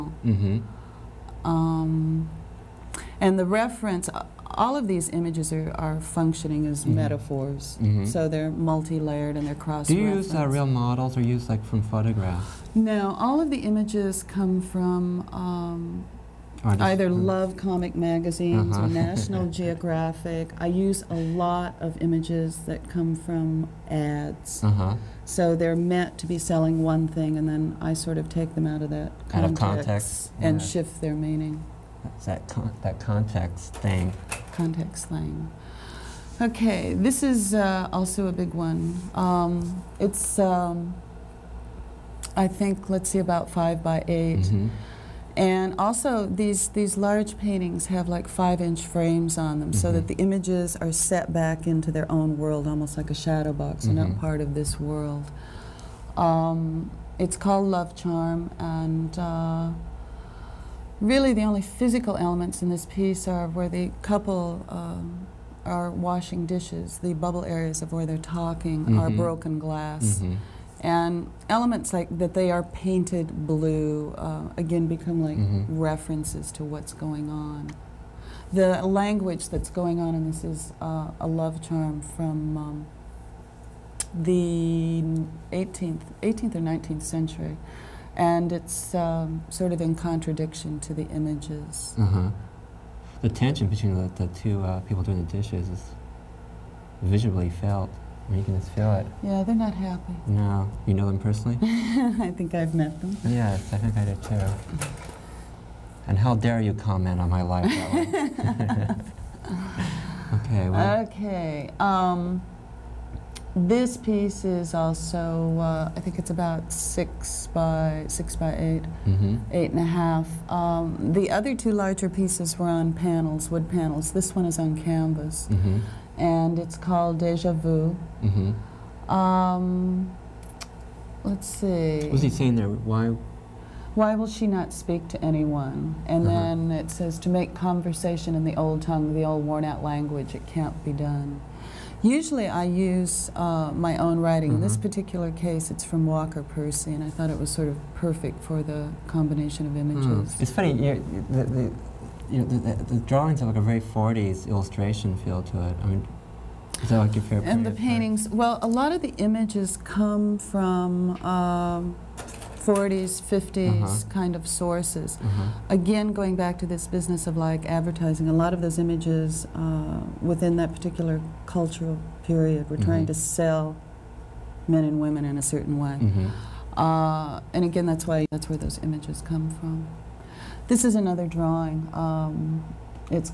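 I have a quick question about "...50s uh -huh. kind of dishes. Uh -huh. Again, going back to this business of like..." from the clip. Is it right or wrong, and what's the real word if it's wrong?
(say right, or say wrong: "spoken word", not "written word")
wrong: "sources", not "dishes".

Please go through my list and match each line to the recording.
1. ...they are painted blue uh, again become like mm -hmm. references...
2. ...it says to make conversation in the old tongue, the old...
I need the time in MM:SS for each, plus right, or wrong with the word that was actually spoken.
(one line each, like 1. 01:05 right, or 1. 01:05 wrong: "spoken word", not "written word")
1. 01:12 right
2. 02:16 right.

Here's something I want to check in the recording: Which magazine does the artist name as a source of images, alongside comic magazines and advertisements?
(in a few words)
National Geographic.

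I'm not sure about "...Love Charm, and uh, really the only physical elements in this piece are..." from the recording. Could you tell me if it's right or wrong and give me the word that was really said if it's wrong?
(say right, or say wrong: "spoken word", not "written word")
right.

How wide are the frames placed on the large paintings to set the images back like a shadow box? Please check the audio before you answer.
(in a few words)
5 inches.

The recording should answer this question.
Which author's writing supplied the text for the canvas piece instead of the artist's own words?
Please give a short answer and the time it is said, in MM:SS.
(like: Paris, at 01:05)
Walker Percy, at 02:26.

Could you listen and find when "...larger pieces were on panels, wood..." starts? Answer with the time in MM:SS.
02:01.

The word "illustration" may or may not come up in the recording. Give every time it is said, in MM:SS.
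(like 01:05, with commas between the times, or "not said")
02:34.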